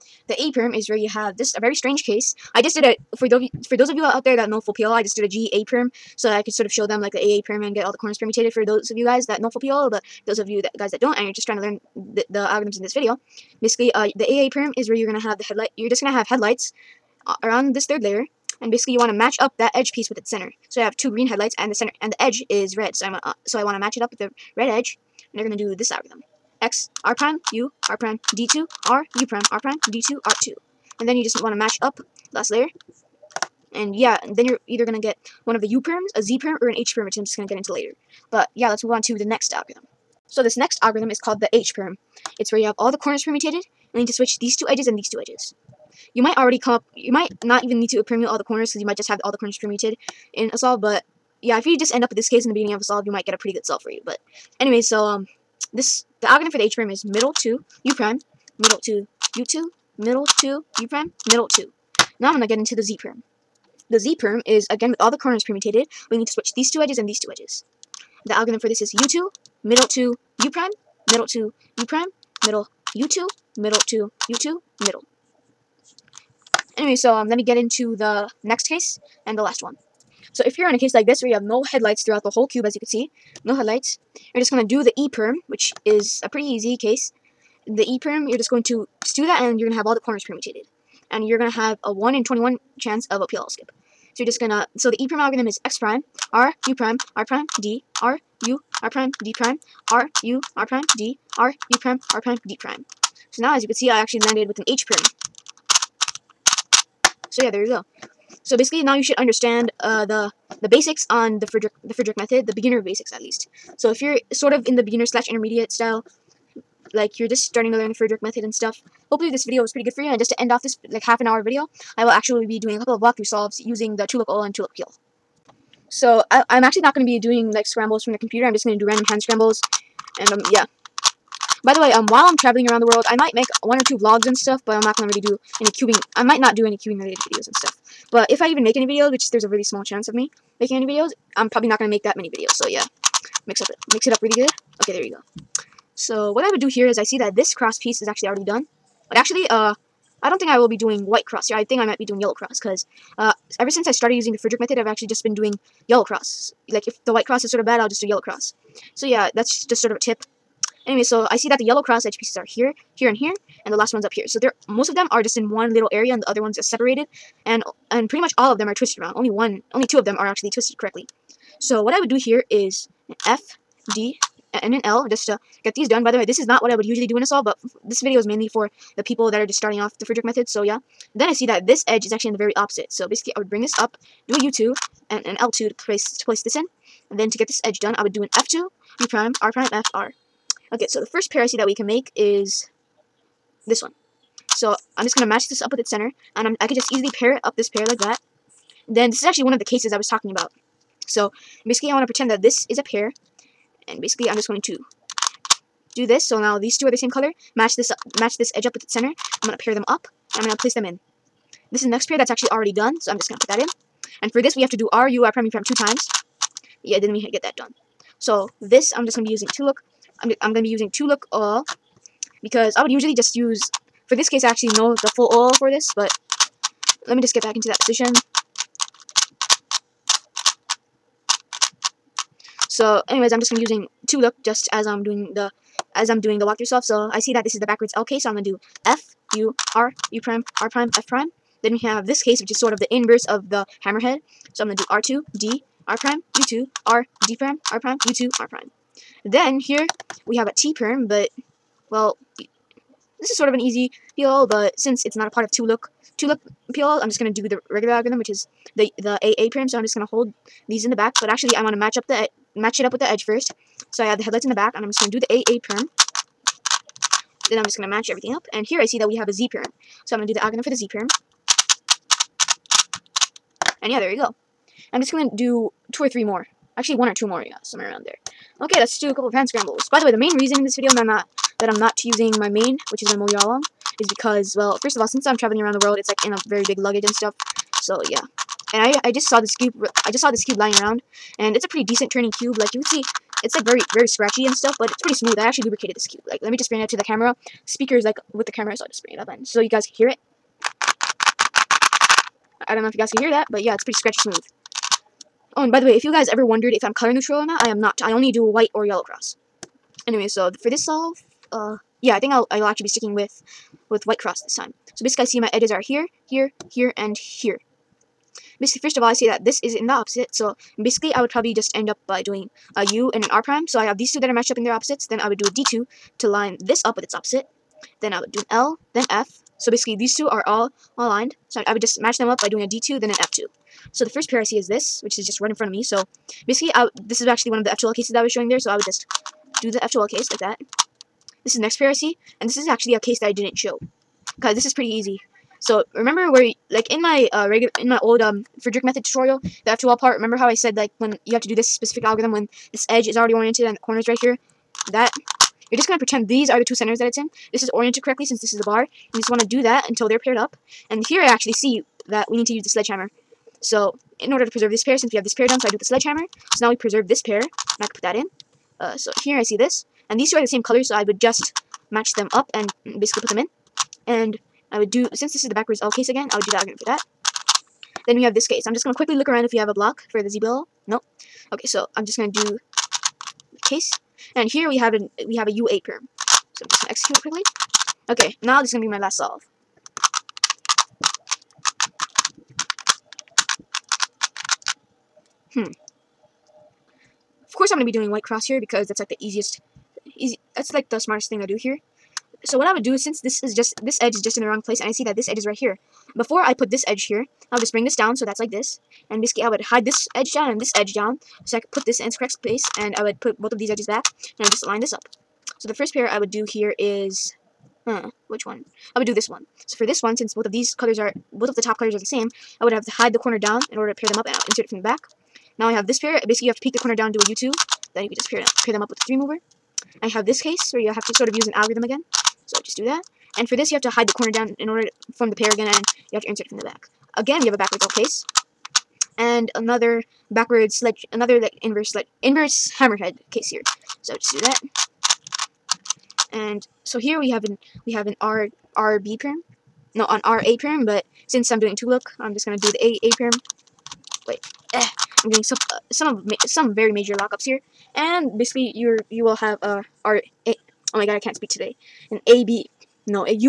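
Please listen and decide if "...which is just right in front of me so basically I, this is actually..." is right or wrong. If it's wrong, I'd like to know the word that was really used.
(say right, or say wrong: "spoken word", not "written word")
right.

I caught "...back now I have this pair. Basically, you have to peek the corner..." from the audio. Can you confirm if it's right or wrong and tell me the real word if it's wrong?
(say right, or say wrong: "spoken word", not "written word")
right.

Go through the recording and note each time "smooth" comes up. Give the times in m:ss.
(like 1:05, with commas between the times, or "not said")
4:55, 5:04.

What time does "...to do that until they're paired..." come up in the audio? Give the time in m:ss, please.
5:59.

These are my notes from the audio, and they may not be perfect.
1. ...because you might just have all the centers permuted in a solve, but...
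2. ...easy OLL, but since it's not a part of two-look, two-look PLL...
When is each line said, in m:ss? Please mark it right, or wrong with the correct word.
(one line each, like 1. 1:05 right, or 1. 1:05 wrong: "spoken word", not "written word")
1. 0:48 wrong: "corners", not "centers"
2. 4:13 wrong: "PLL", not "OLL".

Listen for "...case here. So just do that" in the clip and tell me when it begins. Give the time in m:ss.
7:23.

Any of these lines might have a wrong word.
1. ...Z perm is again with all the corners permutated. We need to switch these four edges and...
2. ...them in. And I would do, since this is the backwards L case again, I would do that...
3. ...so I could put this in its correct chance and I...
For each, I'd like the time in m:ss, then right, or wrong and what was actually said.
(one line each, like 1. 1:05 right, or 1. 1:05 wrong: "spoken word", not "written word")
1. 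1:03 wrong: "two", not "four"
2. 6:13 right
3. 6:51 wrong: "space", not "chance".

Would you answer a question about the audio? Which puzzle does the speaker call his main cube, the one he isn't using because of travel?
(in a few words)
MoYu AoLong.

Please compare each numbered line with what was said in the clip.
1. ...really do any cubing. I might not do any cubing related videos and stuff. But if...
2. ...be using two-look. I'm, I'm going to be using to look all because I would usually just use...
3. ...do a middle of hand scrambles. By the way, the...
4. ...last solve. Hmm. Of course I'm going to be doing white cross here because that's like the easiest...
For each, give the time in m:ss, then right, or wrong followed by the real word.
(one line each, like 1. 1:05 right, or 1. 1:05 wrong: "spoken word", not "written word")
1. 2:15 right
2. 3:39 right
3. 4:38 wrong: "couple", not "middle"
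4. 6:28 right.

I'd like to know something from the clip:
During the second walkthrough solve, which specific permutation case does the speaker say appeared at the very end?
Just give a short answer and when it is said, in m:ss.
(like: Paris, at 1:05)
Ua perm, at 6:25.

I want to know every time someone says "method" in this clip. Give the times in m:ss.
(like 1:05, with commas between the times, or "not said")
1:52, 1:58, 2:34, 3:00, 5:48.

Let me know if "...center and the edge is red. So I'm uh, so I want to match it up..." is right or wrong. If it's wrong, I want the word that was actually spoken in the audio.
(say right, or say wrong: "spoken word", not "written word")
right.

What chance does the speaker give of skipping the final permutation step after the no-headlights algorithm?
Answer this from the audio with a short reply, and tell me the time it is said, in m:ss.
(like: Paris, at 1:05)
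1 in 21, at 1:31.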